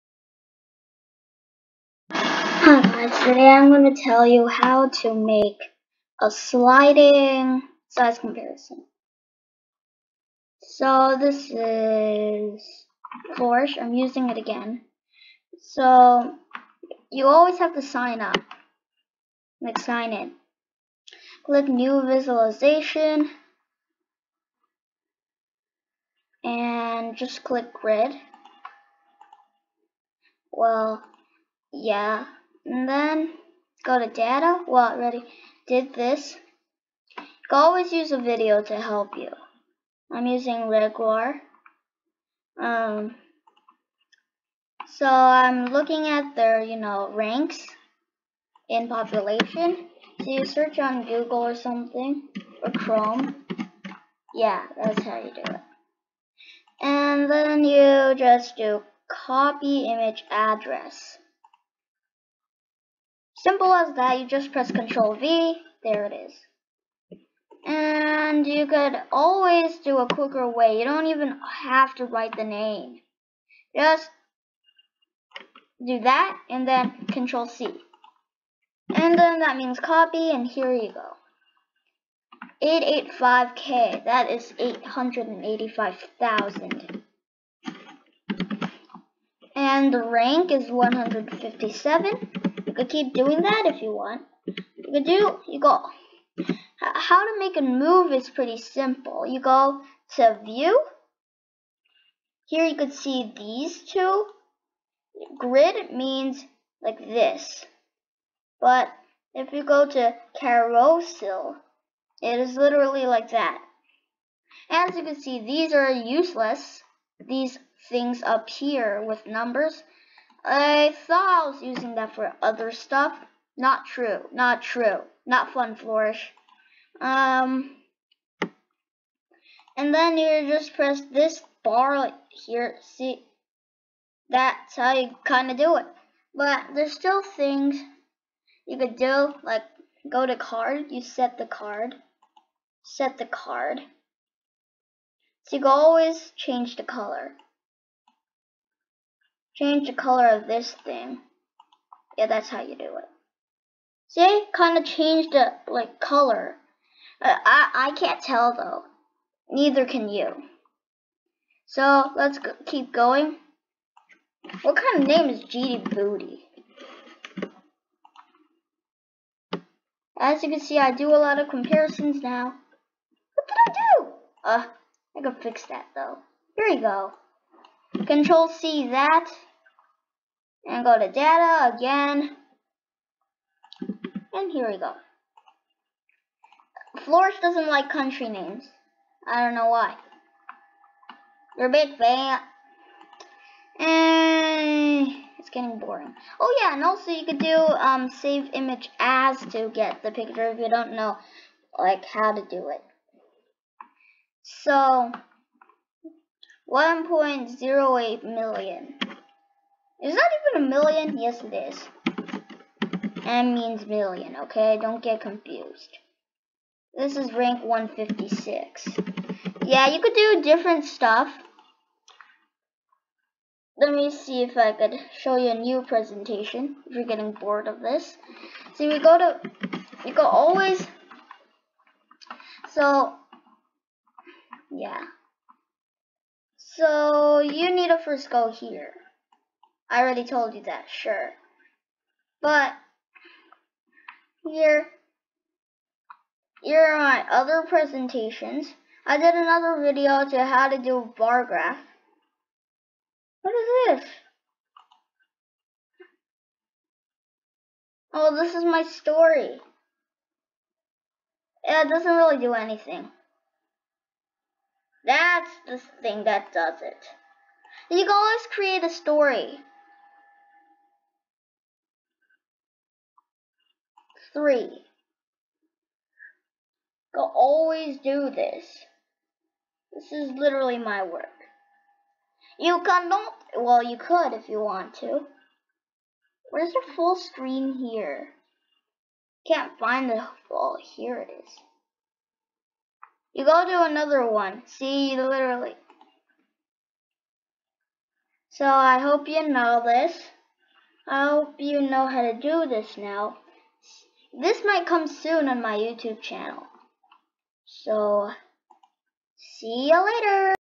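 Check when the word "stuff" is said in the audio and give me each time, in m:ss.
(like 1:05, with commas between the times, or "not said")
2:02, 3:40.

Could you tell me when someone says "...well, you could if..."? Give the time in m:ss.
4:43.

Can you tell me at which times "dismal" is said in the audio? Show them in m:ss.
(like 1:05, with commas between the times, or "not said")
not said.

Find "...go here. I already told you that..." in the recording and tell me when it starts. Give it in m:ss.
3:58.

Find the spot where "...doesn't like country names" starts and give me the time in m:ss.
3:07.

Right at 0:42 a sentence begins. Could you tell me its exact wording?
Um, so I'm looking at their, you know, ranks in population.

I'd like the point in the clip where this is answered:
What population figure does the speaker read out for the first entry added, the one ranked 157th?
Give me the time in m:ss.
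1:24.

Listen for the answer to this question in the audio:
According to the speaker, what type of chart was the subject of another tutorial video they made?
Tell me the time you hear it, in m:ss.
4:11.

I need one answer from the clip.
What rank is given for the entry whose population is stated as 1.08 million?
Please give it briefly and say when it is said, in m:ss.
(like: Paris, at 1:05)
156, at 3:37.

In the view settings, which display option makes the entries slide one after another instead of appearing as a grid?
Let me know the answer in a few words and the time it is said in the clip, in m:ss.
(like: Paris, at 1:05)
carousel, at 1:50.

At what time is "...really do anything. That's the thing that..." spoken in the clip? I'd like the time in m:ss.
4:22.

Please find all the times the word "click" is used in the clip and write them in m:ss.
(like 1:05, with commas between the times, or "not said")
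0:21, 0:27.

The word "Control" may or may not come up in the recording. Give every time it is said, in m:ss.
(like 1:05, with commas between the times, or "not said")
1:04, 1:17, 2:58.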